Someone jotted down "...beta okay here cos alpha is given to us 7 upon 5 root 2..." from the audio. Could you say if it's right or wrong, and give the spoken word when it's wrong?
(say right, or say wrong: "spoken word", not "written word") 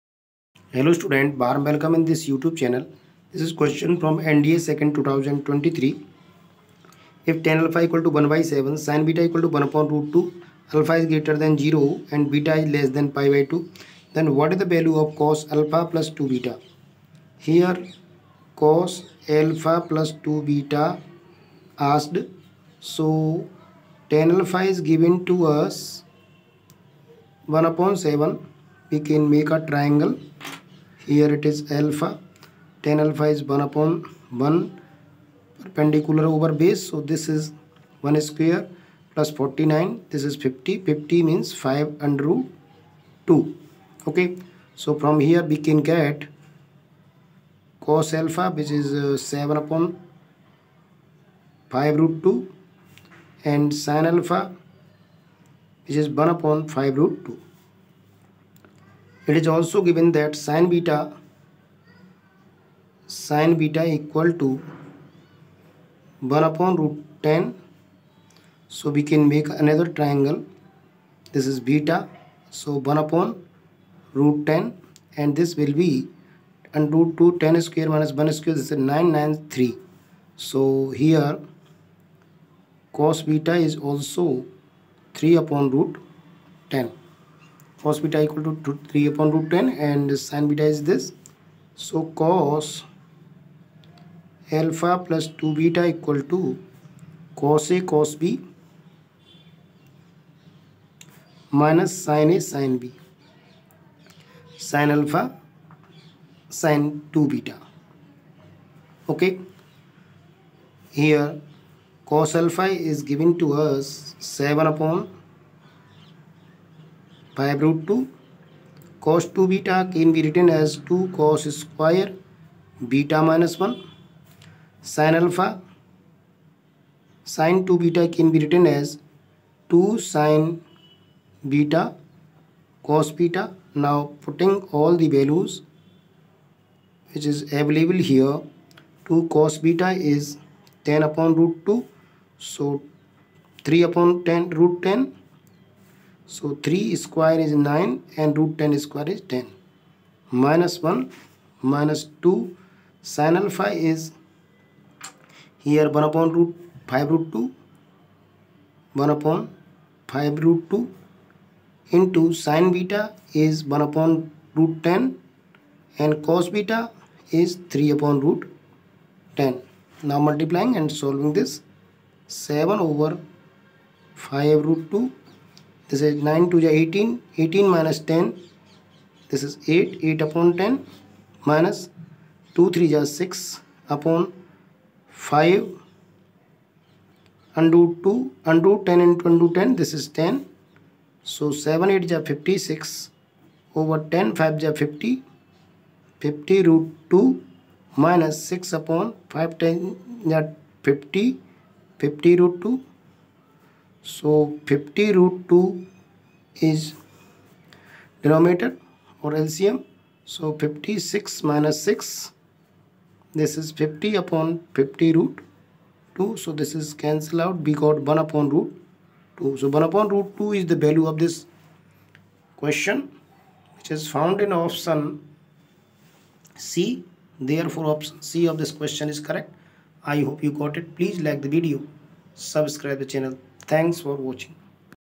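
right.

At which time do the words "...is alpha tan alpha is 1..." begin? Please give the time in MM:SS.
00:31.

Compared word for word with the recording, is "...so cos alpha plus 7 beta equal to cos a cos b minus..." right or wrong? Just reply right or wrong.
wrong.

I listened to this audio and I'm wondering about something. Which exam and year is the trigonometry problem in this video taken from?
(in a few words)
NDA 2nd 2023.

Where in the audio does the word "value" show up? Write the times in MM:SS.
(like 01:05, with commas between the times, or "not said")
00:14, 02:15, 03:40.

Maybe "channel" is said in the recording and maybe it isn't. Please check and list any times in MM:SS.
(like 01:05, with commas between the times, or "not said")
00:02, 03:53.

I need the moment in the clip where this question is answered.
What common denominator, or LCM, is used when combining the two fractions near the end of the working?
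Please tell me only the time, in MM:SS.
03:24.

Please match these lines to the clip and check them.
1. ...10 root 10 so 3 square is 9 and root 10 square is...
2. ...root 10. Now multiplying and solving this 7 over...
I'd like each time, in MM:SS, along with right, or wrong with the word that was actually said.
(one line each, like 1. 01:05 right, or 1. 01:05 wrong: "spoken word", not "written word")
1. 02:24 right
2. 02:48 right.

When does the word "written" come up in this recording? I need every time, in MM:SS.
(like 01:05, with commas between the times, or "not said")
02:00, 02:08.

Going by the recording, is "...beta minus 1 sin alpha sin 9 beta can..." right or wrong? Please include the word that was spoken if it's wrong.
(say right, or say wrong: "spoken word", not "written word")
wrong: "2", not "9".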